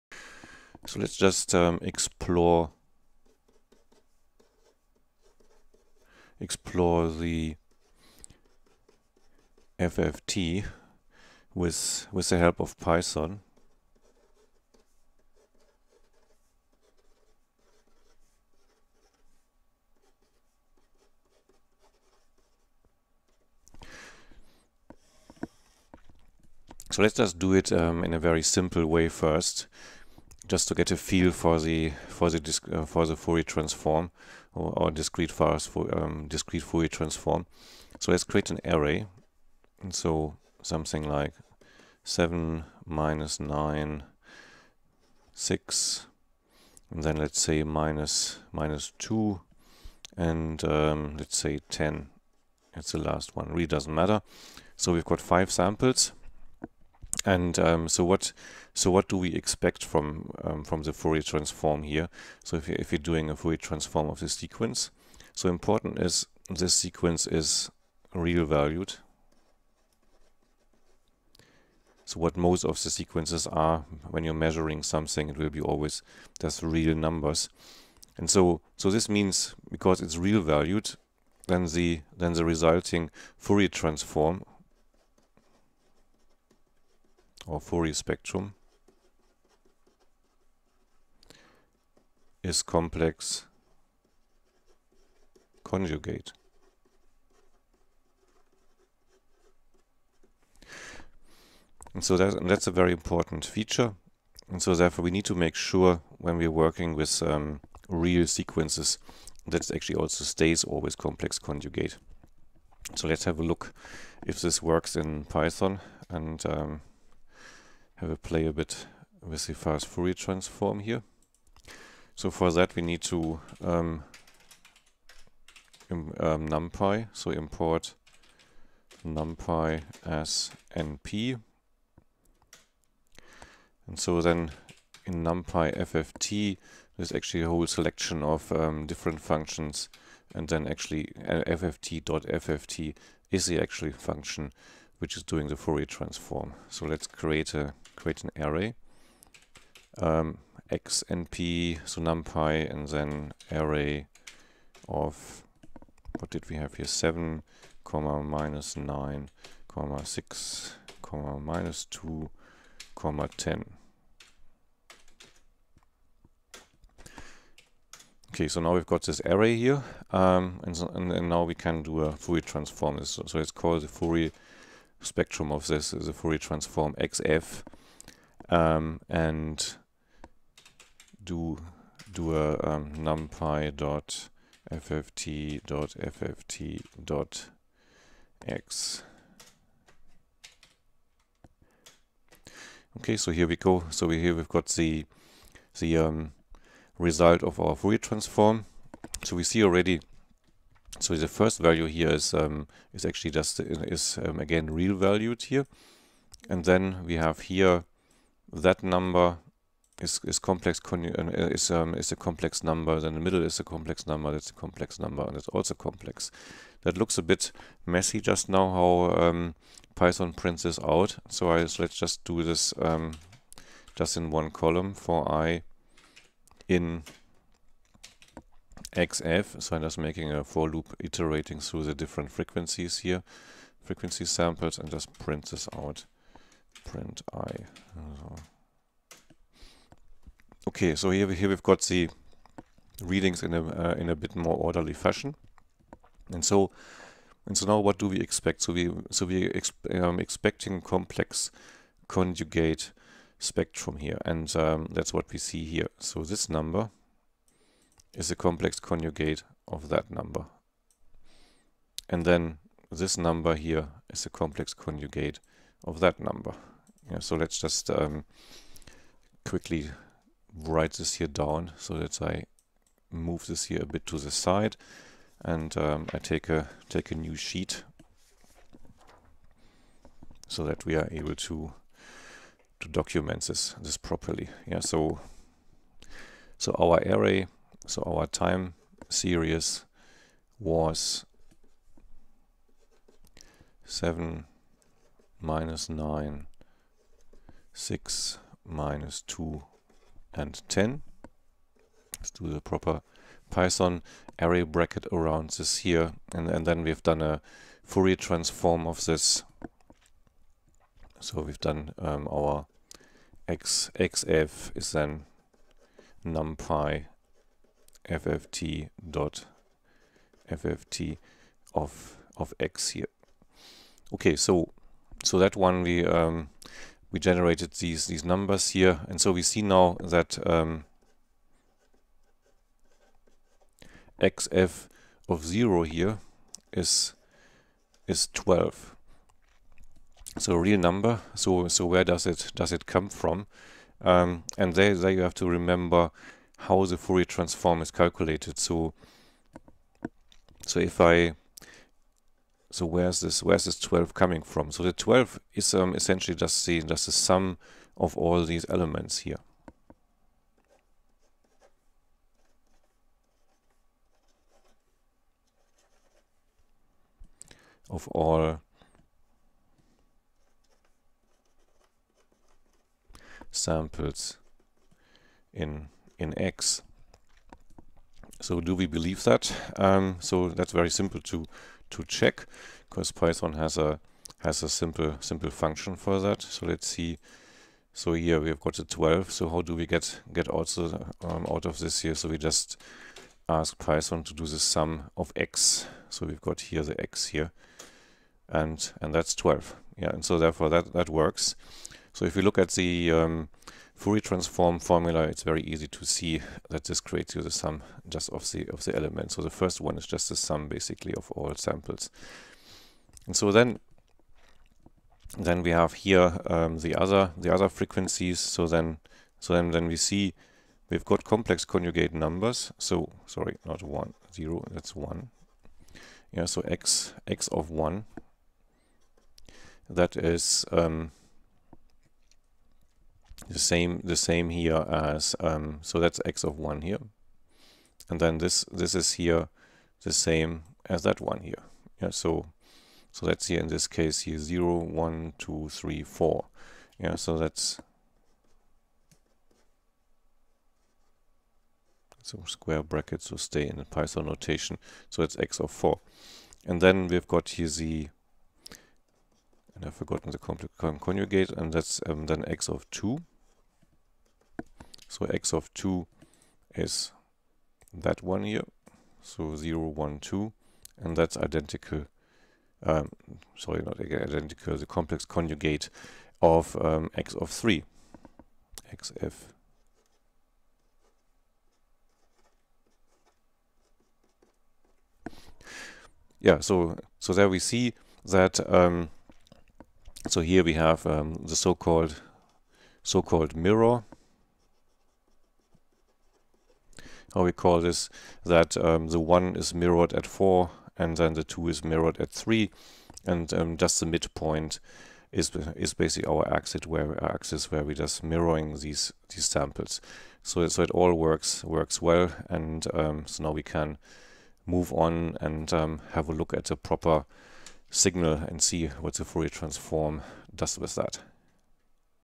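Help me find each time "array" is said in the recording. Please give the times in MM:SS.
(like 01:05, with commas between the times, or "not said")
00:38, 02:28, 02:33, 02:49, 04:47, 05:04.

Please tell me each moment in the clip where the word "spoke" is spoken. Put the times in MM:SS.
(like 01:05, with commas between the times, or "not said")
not said.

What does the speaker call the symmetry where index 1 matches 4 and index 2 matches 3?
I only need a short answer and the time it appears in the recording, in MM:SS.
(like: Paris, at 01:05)
mirror, at 08:13.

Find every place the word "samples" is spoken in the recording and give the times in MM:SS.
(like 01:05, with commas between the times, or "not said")
00:55, 03:54, 06:13, 06:51, 08:29.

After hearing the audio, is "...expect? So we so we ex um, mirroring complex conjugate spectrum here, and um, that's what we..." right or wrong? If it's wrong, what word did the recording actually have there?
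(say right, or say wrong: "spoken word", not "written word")
wrong: "expecting", not "mirroring".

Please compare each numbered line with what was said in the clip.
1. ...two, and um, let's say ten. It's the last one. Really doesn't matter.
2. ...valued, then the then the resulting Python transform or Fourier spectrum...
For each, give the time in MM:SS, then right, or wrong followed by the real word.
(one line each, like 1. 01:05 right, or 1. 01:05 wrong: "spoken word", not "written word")
1. 00:48 right
2. 01:20 wrong: "Fourier", not "Python".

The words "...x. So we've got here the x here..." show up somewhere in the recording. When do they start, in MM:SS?
06:35.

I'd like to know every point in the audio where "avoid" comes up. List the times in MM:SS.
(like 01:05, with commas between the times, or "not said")
not said.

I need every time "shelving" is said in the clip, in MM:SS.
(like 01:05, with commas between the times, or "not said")
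not said.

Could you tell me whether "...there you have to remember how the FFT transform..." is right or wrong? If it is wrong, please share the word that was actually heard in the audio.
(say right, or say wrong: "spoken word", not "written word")
wrong: "Fourier", not "FFT".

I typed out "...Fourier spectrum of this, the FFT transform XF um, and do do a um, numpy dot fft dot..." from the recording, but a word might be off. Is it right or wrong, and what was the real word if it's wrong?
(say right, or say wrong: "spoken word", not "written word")
wrong: "Fourier", not "FFT".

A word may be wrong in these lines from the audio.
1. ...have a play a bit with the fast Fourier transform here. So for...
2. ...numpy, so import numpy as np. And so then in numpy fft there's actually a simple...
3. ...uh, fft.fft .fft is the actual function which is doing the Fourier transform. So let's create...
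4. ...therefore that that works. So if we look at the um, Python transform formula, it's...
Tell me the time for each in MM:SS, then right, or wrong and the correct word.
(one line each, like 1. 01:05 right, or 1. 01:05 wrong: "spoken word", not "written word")
1. 01:58 right
2. 02:06 wrong: "whole", not "simple"
3. 02:21 right
4. 06:40 wrong: "Fourier", not "Python".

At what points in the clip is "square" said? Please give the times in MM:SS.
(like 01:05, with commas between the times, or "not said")
07:32.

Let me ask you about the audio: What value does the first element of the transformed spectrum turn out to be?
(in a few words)
12.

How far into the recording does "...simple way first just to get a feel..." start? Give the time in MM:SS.
00:28.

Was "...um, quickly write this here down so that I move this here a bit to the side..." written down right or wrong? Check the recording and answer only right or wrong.
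right.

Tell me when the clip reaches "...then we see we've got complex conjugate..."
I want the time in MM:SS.
06:59.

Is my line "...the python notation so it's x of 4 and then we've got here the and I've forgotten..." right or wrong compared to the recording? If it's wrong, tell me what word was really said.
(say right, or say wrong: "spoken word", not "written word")
right.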